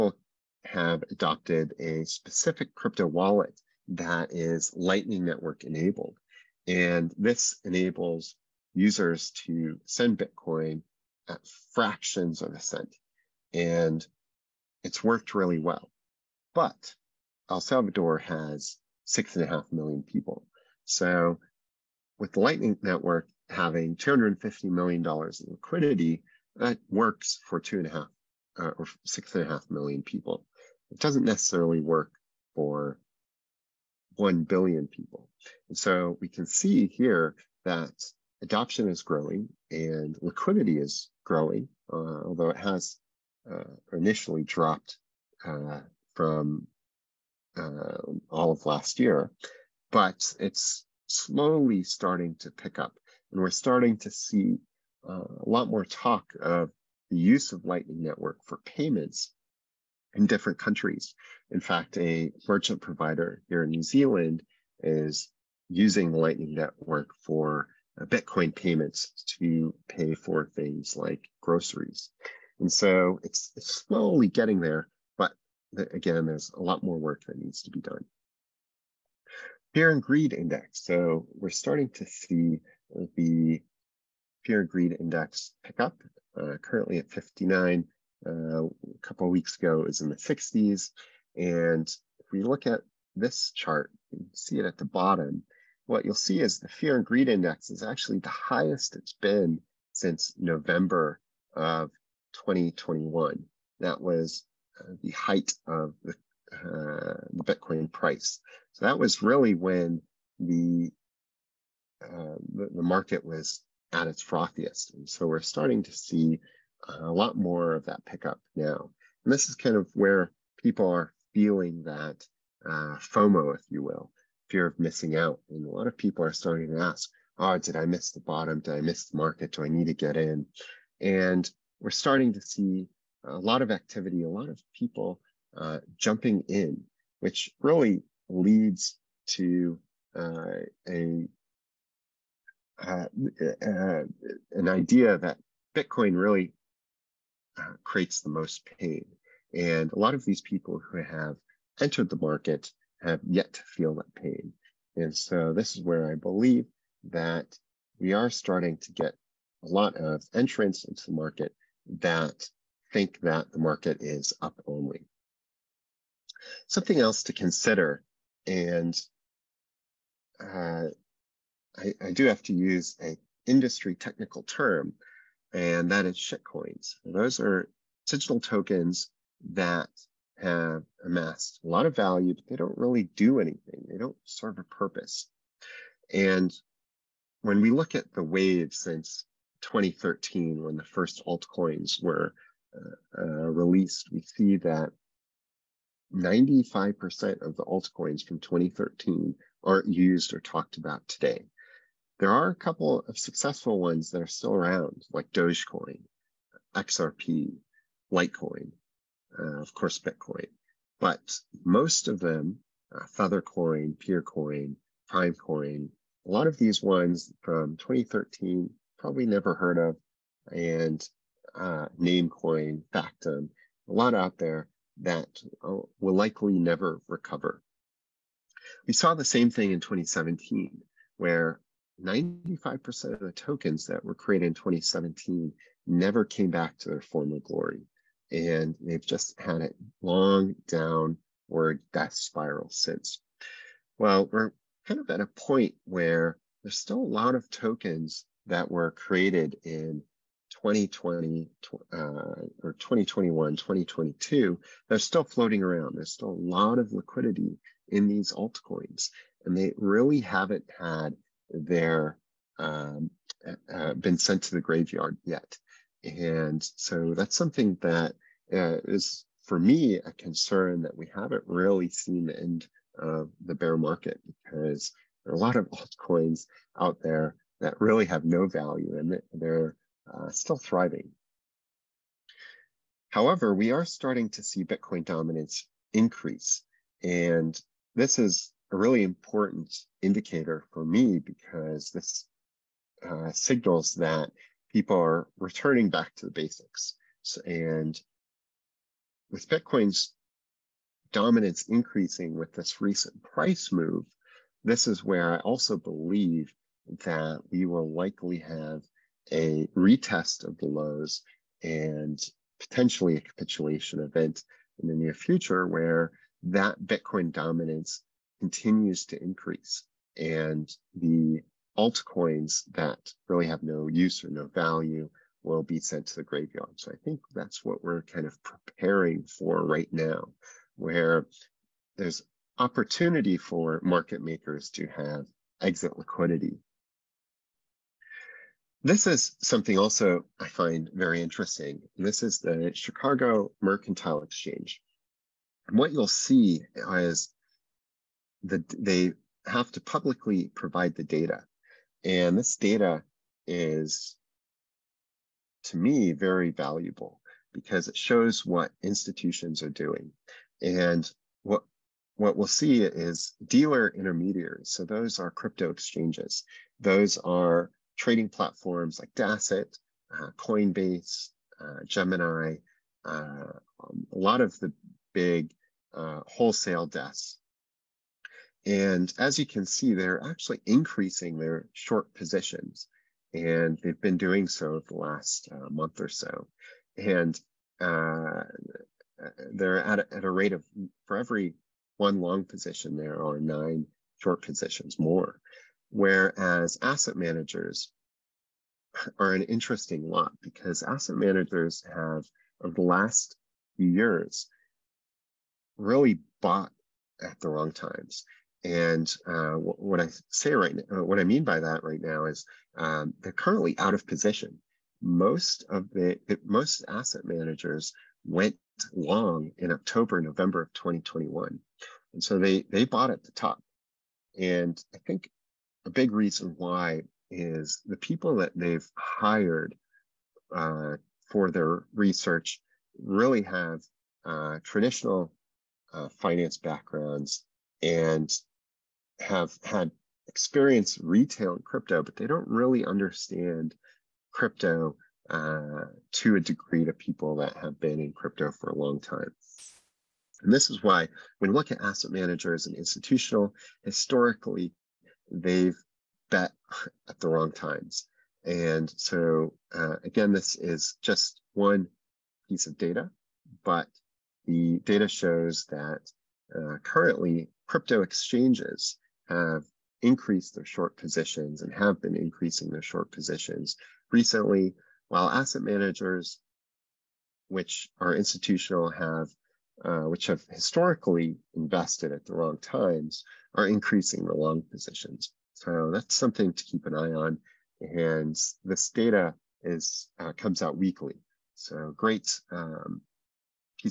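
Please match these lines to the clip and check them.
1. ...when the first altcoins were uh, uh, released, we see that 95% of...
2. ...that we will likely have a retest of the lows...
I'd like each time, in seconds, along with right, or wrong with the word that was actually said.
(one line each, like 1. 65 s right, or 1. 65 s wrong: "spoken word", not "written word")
1. 190 s right
2. 307 s right.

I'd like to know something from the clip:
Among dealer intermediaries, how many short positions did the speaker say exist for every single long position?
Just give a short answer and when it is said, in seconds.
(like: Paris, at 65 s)
9, at 393 s.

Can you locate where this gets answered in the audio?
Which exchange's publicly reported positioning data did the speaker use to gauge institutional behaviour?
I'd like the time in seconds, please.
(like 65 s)
342 s.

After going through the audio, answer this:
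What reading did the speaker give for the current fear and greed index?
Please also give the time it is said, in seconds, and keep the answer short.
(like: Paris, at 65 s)
59, at 87 s.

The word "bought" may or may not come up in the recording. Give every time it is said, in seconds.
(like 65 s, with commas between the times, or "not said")
406 s, 422 s.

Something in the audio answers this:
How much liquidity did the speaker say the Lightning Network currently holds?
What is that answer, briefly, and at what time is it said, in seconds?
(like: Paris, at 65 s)
$250 million, at 23 s.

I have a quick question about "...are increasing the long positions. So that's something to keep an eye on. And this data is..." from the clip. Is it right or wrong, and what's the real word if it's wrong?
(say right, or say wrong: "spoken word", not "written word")
right.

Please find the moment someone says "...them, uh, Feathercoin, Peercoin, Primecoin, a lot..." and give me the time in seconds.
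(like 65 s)
212 s.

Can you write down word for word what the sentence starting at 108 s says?
So that was really when the, uh, the, the market was at its frothiest.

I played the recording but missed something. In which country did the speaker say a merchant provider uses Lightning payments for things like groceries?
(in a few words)
New Zealand.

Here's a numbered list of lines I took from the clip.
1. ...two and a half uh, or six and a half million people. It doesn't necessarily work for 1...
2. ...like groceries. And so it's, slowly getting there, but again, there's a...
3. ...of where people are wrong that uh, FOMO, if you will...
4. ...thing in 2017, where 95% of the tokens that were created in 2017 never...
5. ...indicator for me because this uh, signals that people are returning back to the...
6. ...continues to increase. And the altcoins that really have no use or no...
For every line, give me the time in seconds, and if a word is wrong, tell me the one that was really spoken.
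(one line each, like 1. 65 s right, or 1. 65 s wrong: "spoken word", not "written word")
1. 27 s right
2. 70 s right
3. 119 s wrong: "feeling", not "wrong"
4. 229 s right
5. 290 s right
6. 318 s right.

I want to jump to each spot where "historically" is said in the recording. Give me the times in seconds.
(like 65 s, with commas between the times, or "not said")
453 s, 480 s.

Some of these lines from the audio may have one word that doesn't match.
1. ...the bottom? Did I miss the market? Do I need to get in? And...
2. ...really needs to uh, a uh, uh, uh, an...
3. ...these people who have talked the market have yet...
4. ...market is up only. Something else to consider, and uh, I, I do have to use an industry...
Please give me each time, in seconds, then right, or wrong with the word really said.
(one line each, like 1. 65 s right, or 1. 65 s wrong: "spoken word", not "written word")
1. 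128 s right
2. 137 s wrong: "leads", not "needs"
3. 150 s wrong: "entered", not "talked"
4. 163 s right.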